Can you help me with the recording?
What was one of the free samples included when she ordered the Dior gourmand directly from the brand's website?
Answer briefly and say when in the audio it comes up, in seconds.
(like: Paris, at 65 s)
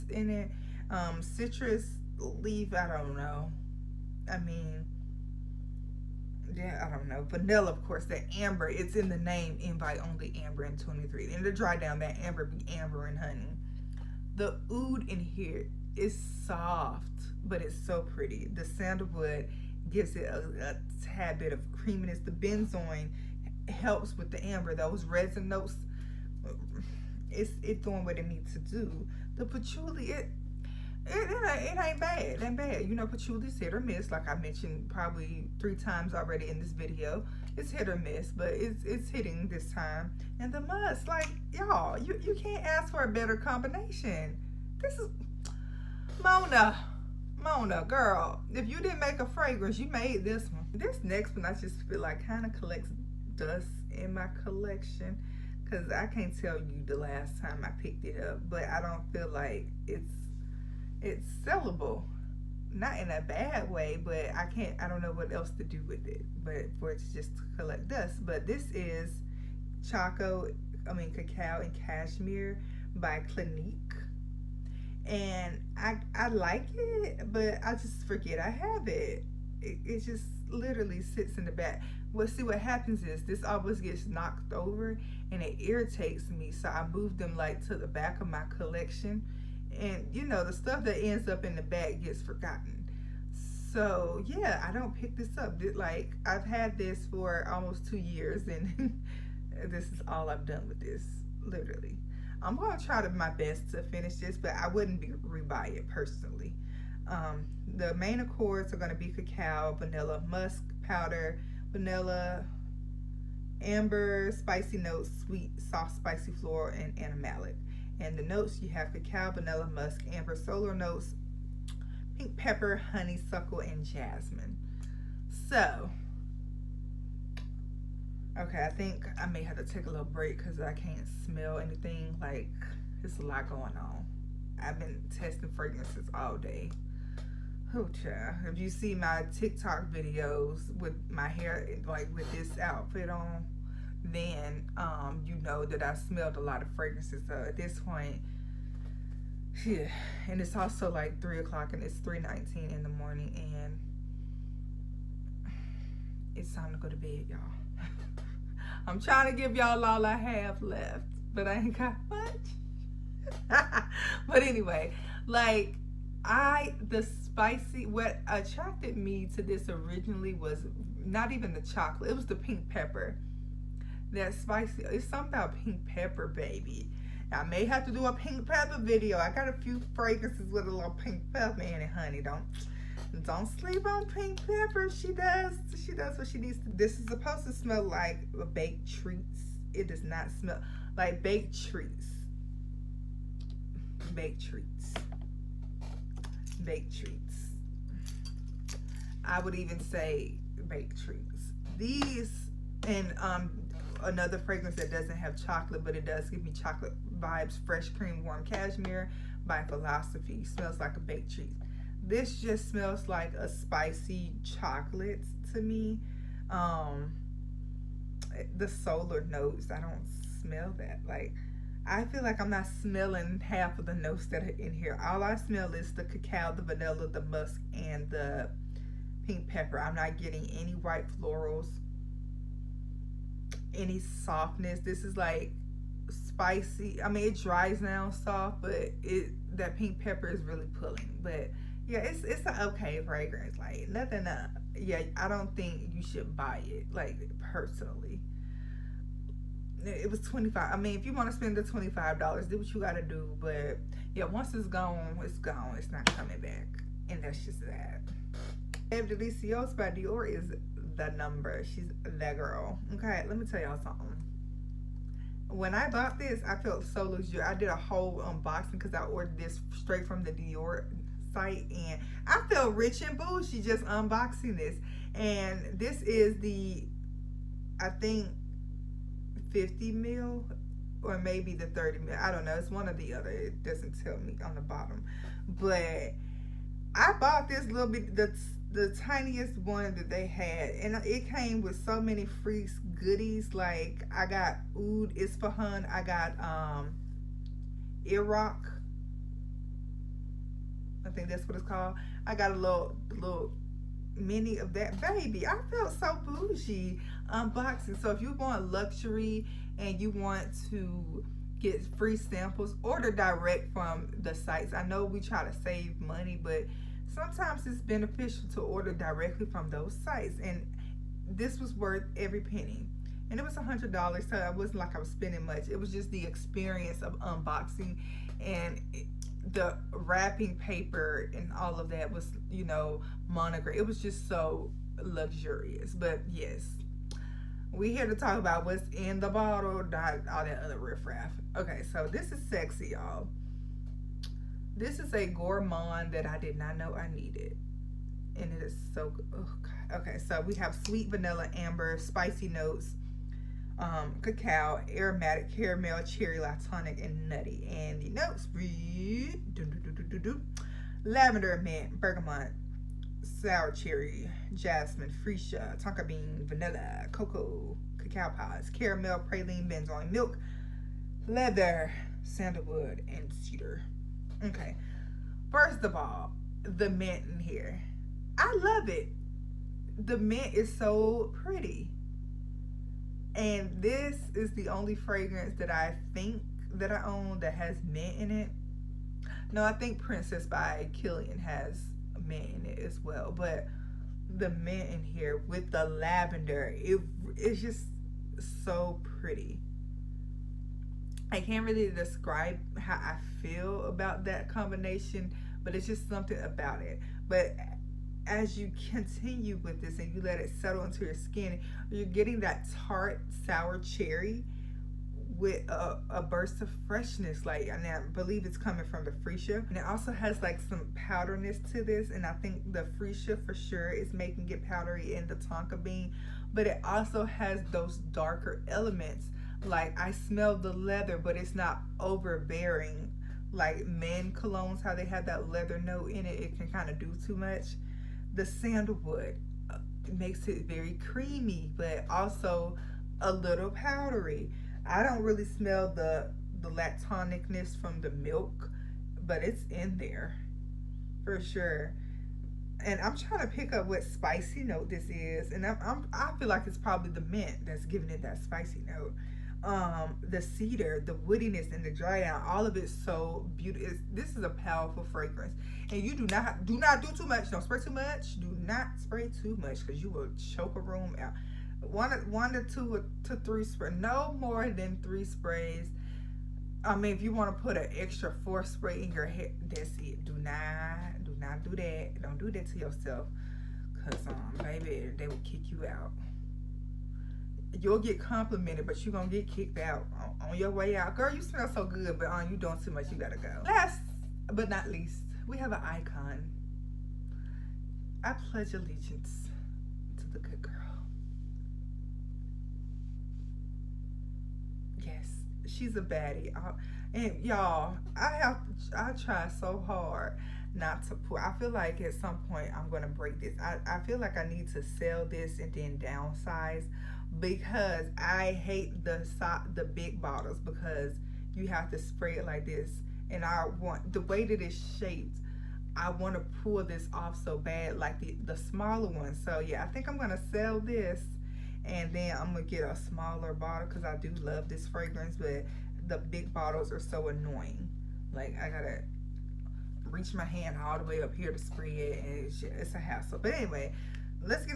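Oud Ispahan, at 294 s.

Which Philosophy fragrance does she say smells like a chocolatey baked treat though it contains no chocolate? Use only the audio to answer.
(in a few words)
Fresh Cream Warm Cashmere.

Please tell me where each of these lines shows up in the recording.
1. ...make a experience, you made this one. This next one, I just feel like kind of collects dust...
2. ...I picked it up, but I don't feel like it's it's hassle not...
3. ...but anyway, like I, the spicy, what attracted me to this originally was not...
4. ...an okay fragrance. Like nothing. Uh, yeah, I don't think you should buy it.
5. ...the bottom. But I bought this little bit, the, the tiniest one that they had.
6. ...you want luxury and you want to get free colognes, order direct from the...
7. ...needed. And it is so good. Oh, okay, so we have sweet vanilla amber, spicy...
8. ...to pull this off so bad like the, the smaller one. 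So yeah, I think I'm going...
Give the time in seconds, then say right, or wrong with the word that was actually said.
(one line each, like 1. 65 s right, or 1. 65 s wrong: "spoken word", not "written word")
1. 48 s wrong: "fragrance", not "experience"
2. 57 s wrong: "sellable", not "hassle"
3. 164 s right
4. 242 s right
5. 284 s right
6. 308 s wrong: "samples", not "colognes"
7. 347 s right
8. 526 s right.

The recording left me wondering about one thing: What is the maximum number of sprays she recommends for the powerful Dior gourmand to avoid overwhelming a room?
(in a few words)
3.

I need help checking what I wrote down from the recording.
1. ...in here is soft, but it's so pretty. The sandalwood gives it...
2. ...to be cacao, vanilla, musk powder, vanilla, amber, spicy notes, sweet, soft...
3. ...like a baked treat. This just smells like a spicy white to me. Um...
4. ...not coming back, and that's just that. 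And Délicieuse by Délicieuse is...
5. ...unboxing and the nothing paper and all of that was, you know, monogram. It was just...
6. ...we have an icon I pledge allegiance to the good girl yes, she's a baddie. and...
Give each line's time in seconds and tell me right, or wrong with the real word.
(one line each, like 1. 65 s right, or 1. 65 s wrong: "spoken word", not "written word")
1. 15 s right
2. 108 s right
3. 210 s wrong: "chocolate", not "white"
4. 255 s wrong: "Dior", not "Délicieuse"
5. 327 s wrong: "wrapping", not "nothing"
6. 495 s right.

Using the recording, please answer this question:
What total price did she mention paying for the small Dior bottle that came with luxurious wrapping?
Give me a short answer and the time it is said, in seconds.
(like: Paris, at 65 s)
$100, at 323 s.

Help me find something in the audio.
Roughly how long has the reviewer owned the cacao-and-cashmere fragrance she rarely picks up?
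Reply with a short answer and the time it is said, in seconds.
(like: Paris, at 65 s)
almost two years, at 97 s.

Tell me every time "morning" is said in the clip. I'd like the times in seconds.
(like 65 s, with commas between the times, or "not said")
152 s.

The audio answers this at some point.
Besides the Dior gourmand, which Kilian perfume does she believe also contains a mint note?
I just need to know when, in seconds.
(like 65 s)
389 s.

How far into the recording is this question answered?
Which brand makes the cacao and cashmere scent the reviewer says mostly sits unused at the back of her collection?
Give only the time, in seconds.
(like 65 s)
73 s.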